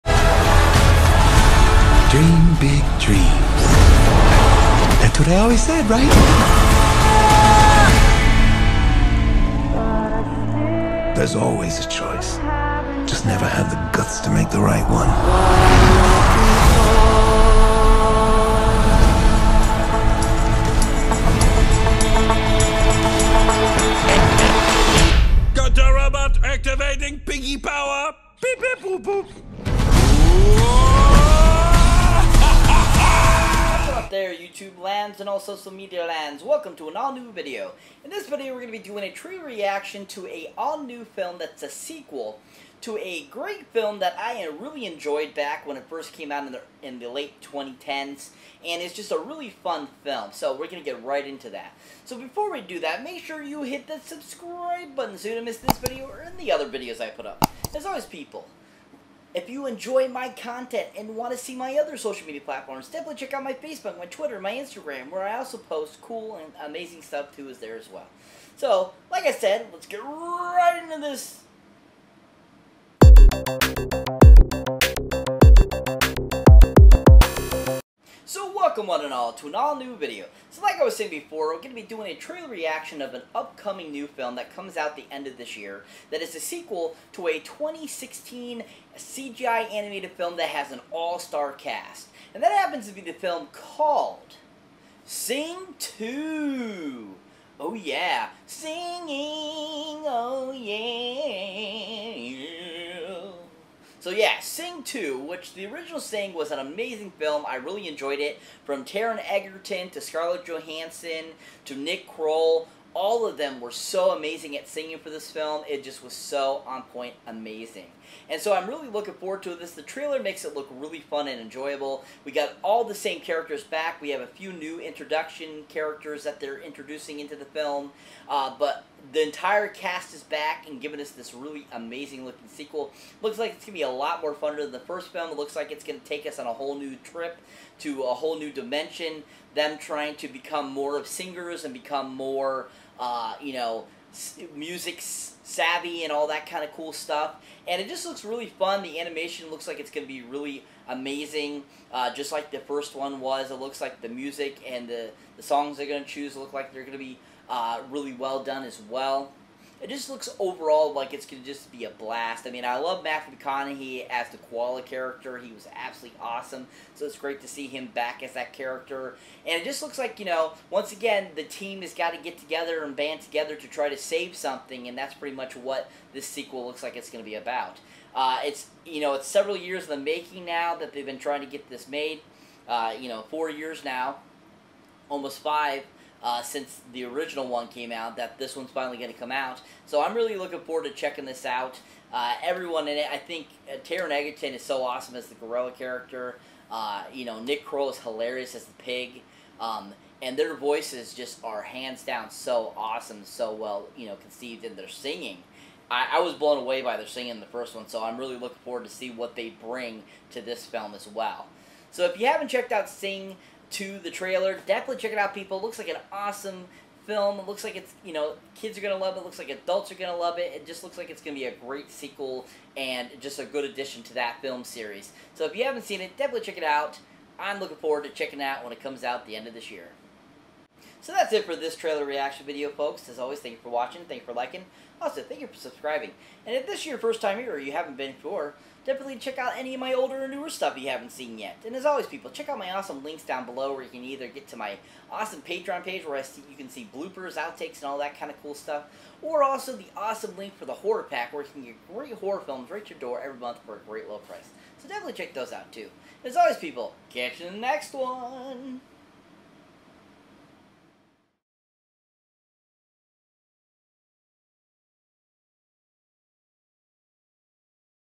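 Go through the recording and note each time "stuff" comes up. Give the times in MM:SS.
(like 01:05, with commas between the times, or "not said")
01:07, 02:26, 04:00, 04:08.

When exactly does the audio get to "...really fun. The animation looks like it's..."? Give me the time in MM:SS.
02:28.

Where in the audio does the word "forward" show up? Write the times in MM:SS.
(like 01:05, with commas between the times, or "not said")
01:59, 03:10, 03:28, 03:47.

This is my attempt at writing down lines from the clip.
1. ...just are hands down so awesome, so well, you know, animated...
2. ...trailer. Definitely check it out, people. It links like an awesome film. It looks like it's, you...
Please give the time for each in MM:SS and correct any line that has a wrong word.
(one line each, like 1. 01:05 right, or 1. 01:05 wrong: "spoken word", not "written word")
1. 03:21 wrong: "conceived", not "animated"
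2. 03:34 wrong: "looks", not "links".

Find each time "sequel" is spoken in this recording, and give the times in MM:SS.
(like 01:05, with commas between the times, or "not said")
00:41, 01:26, 02:12, 02:56, 03:41.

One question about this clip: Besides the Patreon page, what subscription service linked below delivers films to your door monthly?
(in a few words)
The horror pack.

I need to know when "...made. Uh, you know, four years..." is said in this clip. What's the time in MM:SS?
03:01.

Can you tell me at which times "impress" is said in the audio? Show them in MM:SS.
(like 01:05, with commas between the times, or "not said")
not said.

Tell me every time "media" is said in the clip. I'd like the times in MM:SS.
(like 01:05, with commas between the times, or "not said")
00:35, 01:02.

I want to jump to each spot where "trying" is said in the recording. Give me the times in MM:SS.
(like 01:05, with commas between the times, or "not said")
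02:19, 03:01.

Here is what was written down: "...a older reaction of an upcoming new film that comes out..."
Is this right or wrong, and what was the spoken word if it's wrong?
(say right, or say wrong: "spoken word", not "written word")
wrong: "trailer", not "older".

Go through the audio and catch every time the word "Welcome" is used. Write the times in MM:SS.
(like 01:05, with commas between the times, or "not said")
00:36, 01:18.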